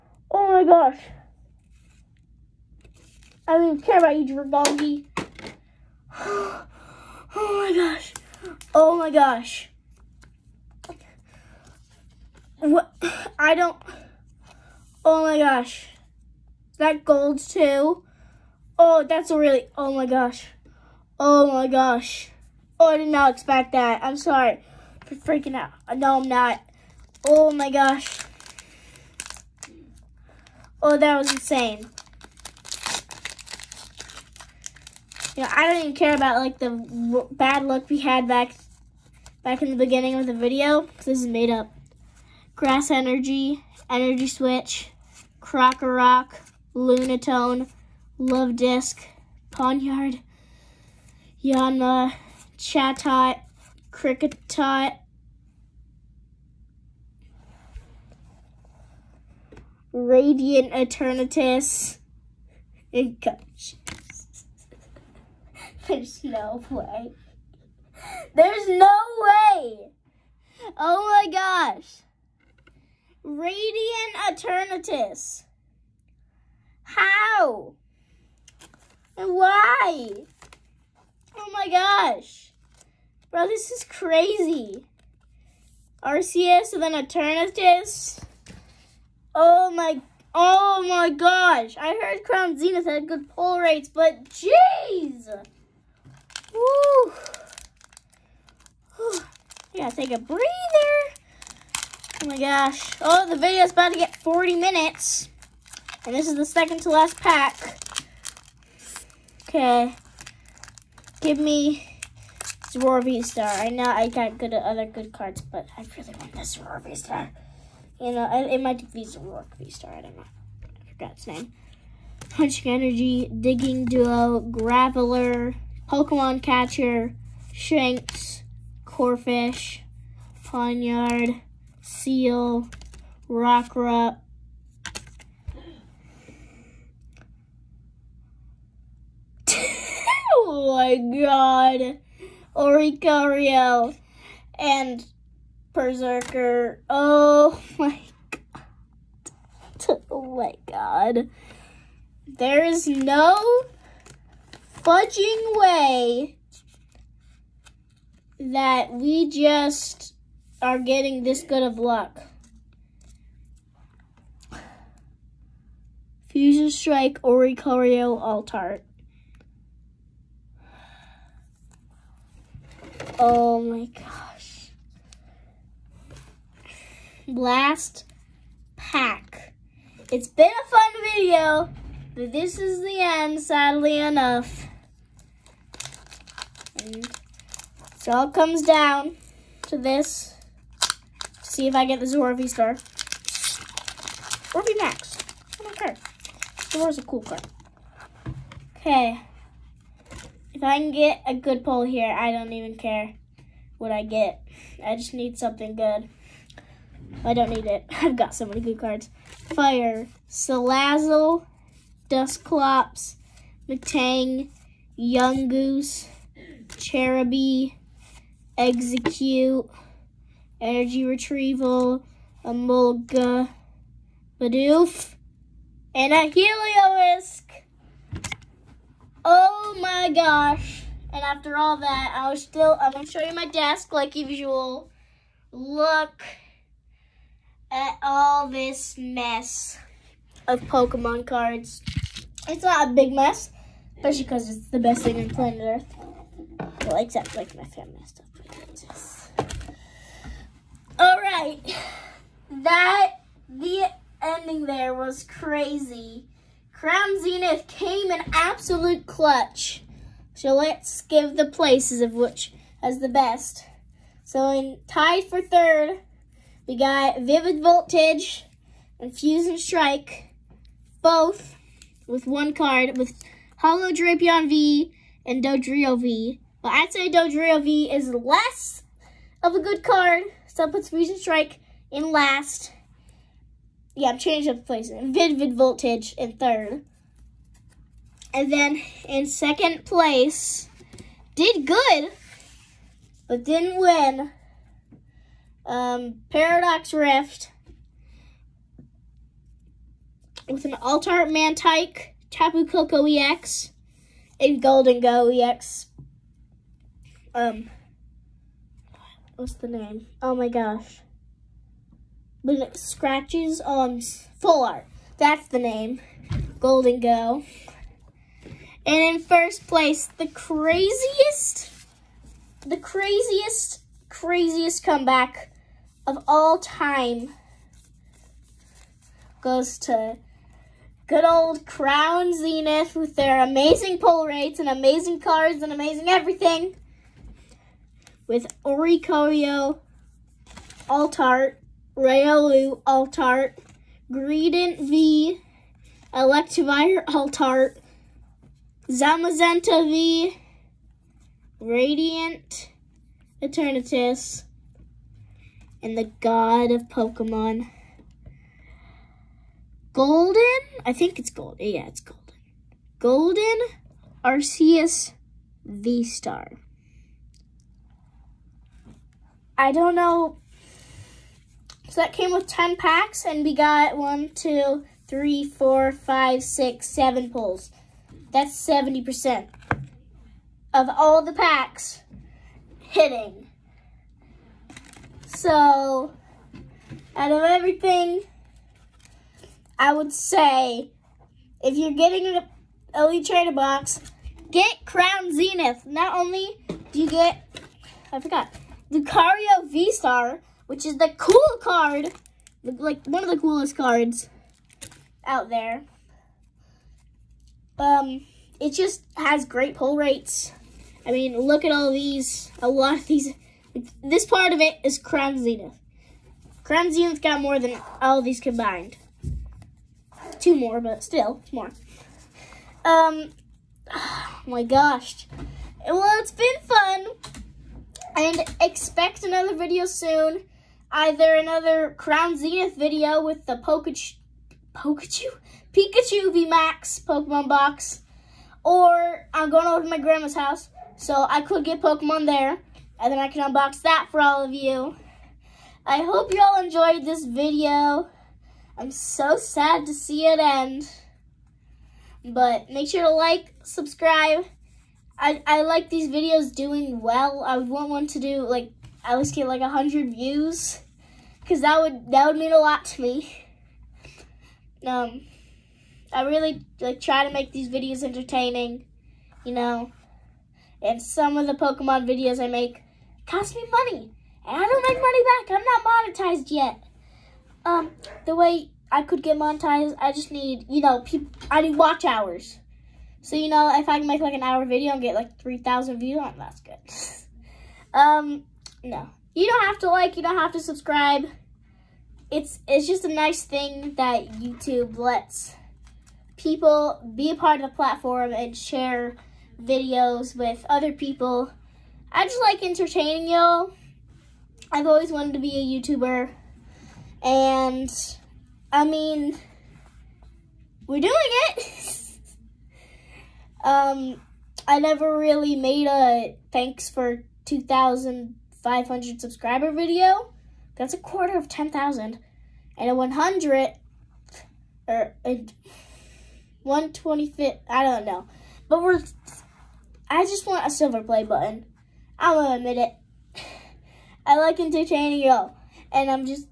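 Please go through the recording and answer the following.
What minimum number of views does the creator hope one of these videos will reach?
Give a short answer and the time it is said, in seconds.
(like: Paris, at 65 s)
100, at 459 s.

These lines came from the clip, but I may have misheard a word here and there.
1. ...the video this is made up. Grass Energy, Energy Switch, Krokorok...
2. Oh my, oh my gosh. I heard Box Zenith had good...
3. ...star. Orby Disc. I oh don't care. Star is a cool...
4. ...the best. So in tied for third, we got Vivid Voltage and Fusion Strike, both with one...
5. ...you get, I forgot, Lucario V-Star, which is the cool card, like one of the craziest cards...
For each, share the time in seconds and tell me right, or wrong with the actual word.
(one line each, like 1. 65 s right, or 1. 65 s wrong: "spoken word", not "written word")
1. 40 s right
2. 89 s wrong: "Crown", not "Box"
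3. 192 s wrong: "Max", not "Disc"
4. 262 s right
5. 396 s wrong: "coolest", not "craziest".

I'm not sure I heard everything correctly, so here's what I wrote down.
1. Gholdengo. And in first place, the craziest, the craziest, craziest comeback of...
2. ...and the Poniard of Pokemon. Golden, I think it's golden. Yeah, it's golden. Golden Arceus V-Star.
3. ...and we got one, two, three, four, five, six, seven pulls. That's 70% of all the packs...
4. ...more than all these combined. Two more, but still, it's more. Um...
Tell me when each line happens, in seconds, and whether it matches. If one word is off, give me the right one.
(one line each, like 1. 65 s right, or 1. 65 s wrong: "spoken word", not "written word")
1. 316 s right
2. 355 s wrong: "God", not "Poniard"
3. 373 s right
4. 417 s right.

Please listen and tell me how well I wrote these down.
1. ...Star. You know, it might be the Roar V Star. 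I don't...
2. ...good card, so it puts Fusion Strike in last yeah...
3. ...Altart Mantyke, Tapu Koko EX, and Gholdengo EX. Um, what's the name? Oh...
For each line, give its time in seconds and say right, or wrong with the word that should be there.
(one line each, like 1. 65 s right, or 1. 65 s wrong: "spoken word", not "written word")
1. 116 s right
2. 279 s right
3. 300 s right.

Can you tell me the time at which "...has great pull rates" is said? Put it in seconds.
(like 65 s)
409 s.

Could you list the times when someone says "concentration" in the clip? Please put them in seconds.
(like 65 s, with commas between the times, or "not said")
not said.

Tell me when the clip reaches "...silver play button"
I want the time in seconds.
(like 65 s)
530 s.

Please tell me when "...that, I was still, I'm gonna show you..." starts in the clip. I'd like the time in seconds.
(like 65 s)
231 s.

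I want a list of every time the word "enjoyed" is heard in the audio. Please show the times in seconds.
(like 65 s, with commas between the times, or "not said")
446 s.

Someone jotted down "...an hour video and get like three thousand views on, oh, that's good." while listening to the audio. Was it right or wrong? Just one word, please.
right.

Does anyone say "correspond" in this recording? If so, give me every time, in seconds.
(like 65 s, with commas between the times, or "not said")
not said.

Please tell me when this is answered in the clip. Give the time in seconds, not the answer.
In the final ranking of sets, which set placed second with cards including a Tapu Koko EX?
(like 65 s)
296 s.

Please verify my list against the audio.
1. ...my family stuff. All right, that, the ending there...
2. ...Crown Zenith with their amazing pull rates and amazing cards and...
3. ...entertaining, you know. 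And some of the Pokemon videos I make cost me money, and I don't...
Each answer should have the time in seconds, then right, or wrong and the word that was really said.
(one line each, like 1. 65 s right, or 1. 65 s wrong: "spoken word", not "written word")
1. 247 s right
2. 331 s right
3. 468 s right.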